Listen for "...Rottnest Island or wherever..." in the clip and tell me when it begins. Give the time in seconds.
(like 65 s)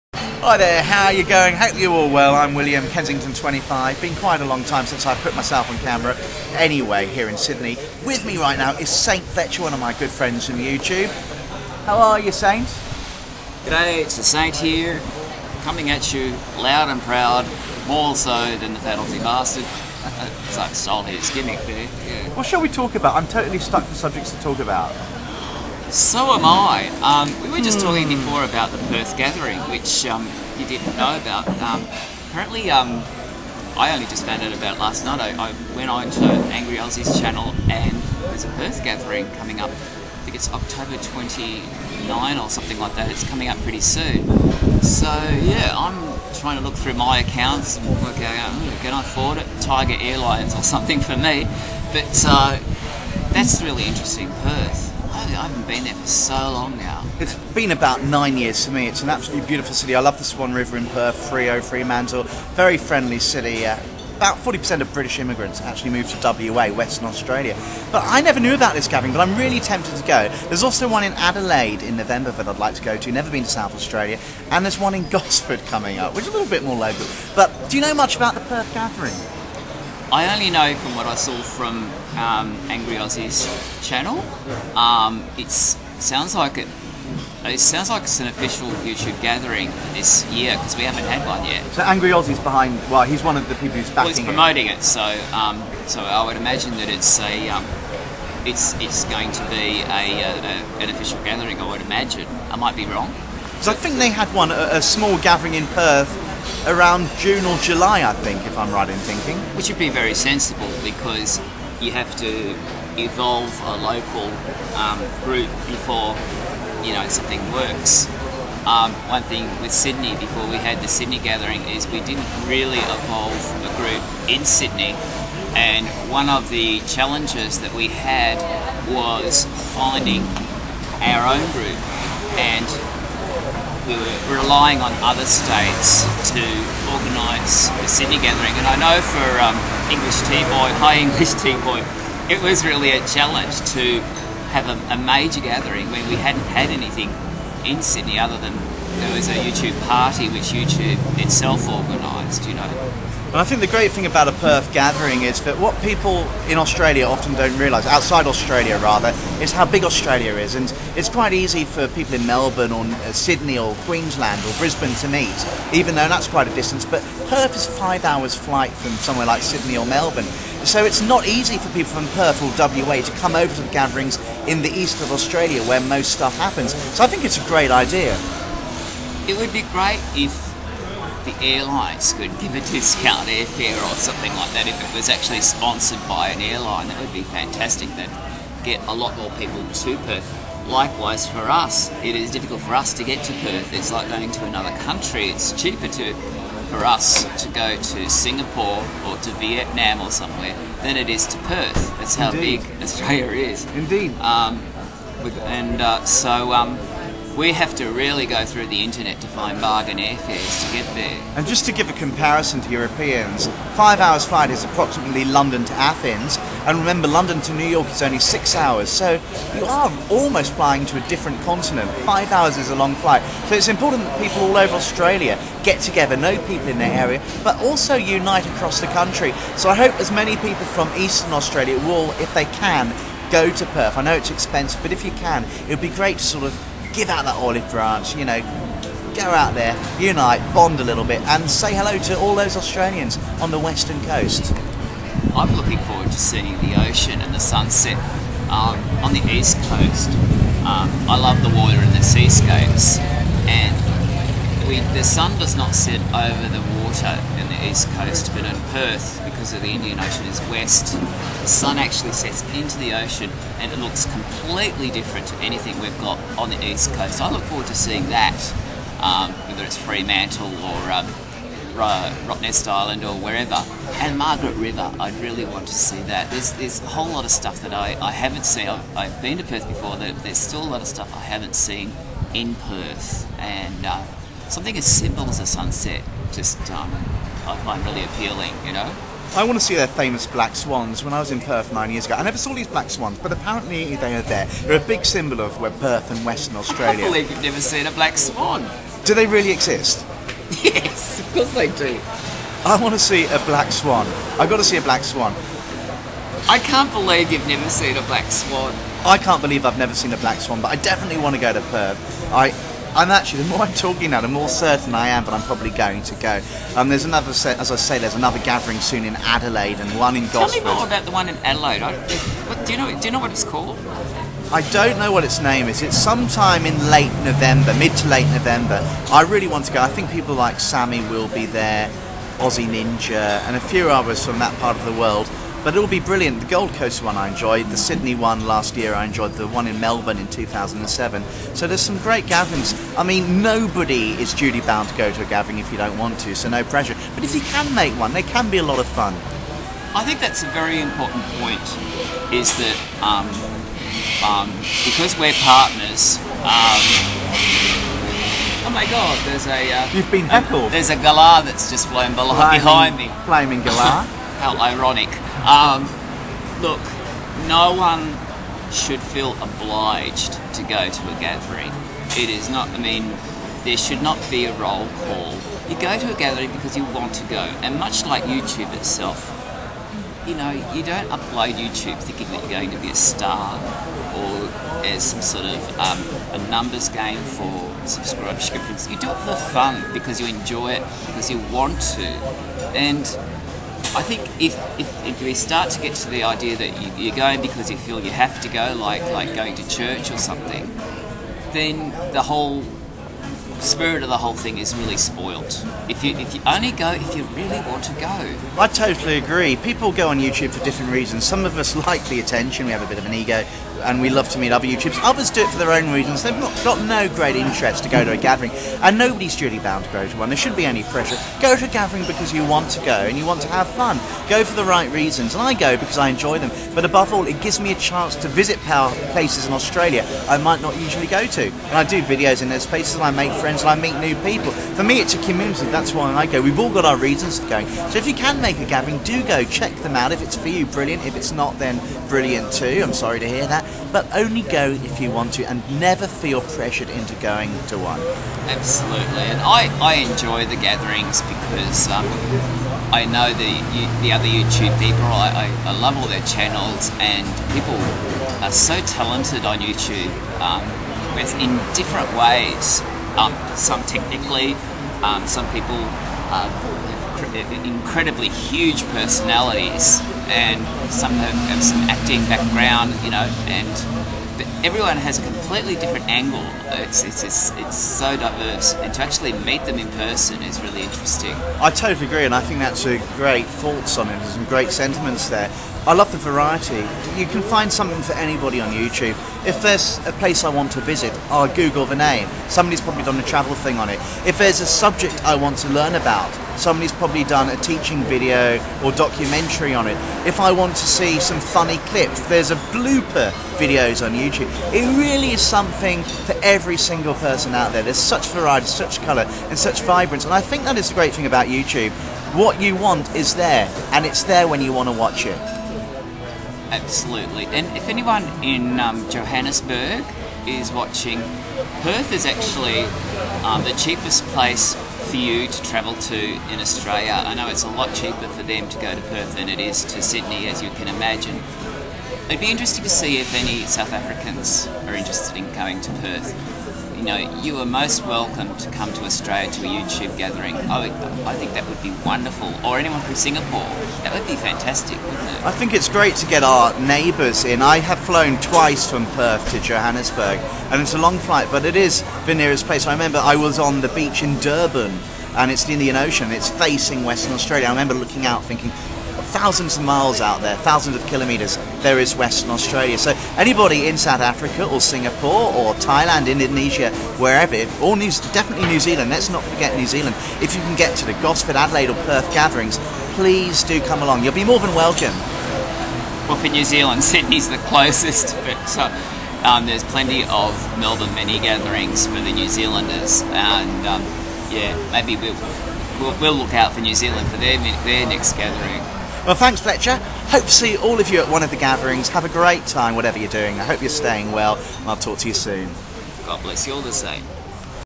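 272 s.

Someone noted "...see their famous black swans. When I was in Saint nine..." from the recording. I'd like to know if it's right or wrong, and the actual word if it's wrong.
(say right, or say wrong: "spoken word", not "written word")
wrong: "Perth", not "Saint".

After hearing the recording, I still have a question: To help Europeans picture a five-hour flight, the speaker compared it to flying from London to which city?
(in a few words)
Athens.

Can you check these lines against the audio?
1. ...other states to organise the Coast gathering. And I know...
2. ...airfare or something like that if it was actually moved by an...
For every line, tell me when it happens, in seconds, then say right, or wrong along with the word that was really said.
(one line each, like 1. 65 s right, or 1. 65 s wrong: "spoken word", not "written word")
1. 135 s wrong: "Sydney", not "Coast"
2. 183 s wrong: "sponsored", not "moved".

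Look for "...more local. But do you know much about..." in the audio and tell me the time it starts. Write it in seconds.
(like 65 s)
76 s.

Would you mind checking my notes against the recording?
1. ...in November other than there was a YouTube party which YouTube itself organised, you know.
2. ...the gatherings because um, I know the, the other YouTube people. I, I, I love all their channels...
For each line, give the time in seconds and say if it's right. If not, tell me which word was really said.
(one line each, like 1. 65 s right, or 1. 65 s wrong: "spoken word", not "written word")
1. 147 s wrong: "Sydney", not "November"
2. 450 s right.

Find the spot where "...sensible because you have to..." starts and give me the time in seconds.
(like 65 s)
110 s.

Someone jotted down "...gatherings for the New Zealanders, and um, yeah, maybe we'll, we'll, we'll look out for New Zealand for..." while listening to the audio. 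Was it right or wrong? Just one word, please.
right.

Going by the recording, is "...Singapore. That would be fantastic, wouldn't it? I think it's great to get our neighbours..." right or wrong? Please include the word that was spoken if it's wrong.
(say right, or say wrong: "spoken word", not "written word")
right.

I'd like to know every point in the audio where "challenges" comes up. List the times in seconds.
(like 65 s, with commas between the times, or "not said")
126 s, 143 s.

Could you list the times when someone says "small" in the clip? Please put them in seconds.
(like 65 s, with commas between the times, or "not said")
104 s.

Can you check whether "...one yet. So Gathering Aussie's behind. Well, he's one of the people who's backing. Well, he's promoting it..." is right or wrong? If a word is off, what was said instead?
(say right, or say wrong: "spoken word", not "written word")
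wrong: "Angry", not "Gathering".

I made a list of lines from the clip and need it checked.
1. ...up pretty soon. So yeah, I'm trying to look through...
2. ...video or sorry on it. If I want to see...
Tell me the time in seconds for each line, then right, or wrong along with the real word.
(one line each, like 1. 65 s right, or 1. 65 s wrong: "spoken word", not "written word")
1. 43 s right
2. 498 s wrong: "documentary", not "sorry".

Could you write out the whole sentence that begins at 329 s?
I think people like Sammy will be there, Aussie Ninja, and a few others from that part of the world.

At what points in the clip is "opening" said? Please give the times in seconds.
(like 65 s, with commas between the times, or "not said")
not said.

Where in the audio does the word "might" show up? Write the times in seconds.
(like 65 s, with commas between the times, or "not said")
102 s, 430 s.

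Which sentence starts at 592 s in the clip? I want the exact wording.
Have a great time, whatever you're doing.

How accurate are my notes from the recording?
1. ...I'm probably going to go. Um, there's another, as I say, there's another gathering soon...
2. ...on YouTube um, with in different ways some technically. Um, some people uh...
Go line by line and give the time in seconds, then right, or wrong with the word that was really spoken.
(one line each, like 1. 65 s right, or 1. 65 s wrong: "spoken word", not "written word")
1. 315 s right
2. 459 s right.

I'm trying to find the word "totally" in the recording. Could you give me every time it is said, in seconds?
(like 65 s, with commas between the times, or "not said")
23 s, 408 s, 481 s.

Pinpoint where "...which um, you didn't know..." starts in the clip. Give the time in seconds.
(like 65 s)
29 s.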